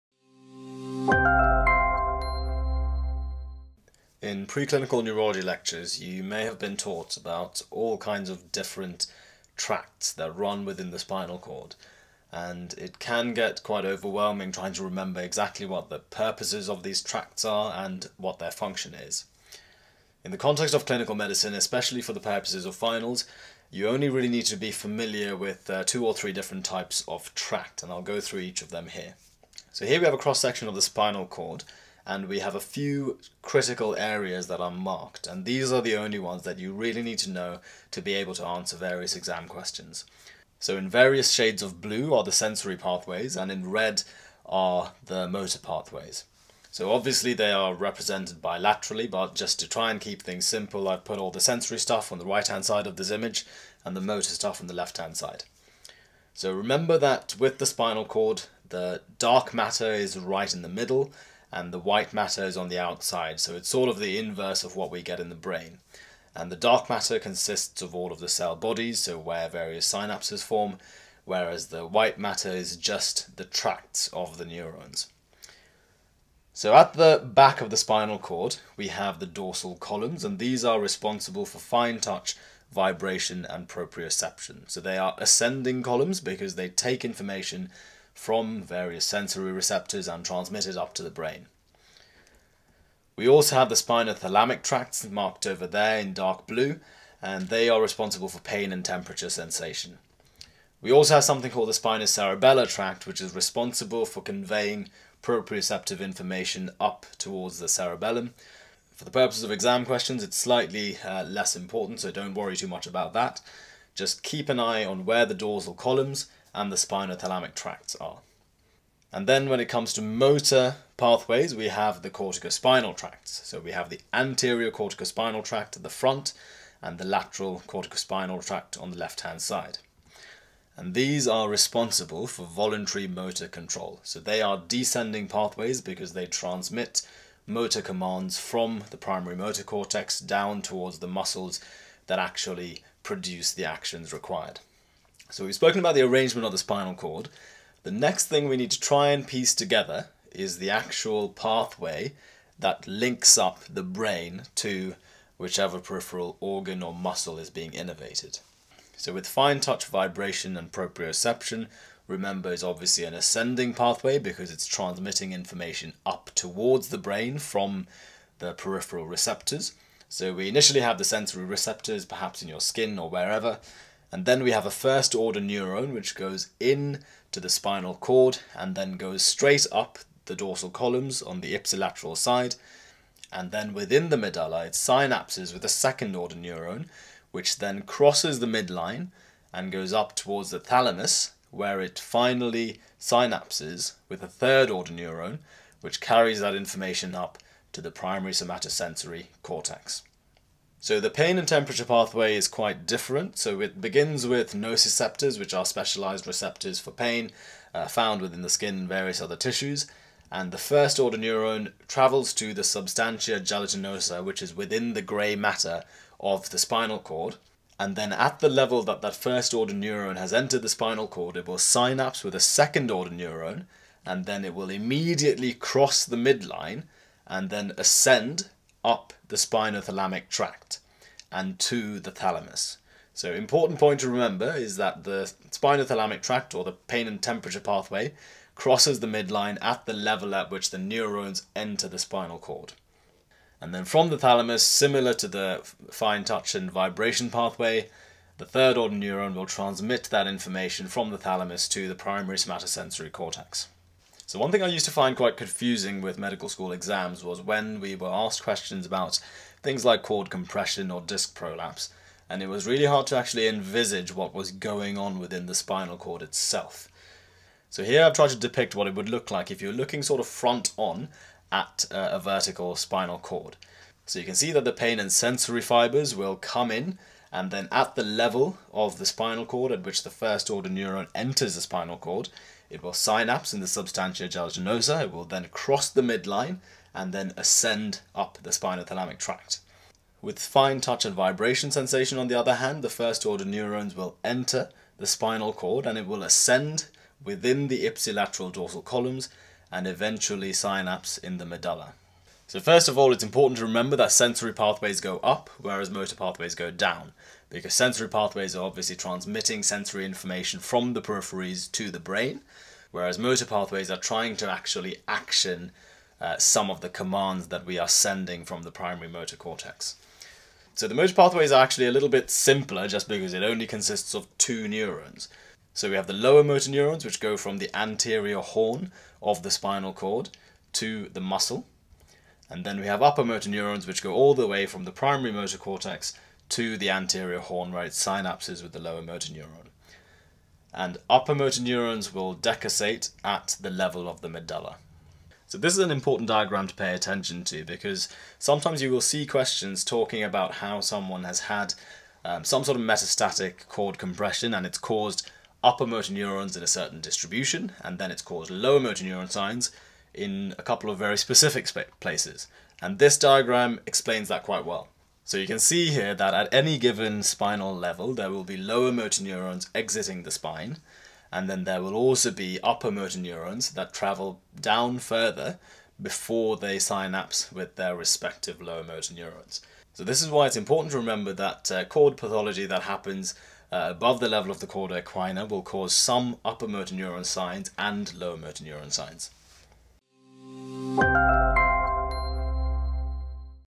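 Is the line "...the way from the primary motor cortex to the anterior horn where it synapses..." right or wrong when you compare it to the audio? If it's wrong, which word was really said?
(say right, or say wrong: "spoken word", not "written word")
right.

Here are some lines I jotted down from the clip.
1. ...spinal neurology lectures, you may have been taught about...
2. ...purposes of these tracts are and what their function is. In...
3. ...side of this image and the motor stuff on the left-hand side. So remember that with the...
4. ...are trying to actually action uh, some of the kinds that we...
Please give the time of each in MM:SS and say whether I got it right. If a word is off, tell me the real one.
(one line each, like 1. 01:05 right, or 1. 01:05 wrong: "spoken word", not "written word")
1. 00:04 wrong: "preclinical", not "spinal"
2. 00:15 right
3. 00:52 right
4. 05:13 wrong: "commands", not "kinds".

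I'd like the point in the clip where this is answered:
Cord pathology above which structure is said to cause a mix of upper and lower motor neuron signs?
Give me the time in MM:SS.
06:24.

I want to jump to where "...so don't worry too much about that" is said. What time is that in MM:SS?
01:51.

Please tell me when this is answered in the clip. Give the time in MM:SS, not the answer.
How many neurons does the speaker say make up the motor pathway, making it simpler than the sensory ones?
05:24.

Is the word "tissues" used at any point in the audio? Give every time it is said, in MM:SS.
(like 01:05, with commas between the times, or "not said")
03:29.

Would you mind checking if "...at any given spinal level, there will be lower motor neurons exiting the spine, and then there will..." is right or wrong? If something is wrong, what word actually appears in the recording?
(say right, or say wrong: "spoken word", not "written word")
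right.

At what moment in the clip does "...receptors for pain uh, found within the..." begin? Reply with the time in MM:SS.
03:26.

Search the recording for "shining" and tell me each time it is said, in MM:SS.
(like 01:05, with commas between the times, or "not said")
not said.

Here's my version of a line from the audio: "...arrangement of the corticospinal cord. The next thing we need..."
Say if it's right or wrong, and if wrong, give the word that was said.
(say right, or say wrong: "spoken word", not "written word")
wrong: "spinal", not "corticospinal".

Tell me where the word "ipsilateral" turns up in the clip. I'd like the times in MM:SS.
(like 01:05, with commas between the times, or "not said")
03:01, 04:57.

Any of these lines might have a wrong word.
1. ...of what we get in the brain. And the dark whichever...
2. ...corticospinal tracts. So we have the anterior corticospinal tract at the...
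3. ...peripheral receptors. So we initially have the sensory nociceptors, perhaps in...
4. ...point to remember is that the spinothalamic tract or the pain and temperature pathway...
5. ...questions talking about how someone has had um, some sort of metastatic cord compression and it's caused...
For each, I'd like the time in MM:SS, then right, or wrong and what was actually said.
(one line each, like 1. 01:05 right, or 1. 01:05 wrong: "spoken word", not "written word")
1. 01:04 wrong: "matter", not "whichever"
2. 02:02 right
3. 02:48 wrong: "receptors", not "nociceptors"
4. 03:53 right
5. 05:49 right.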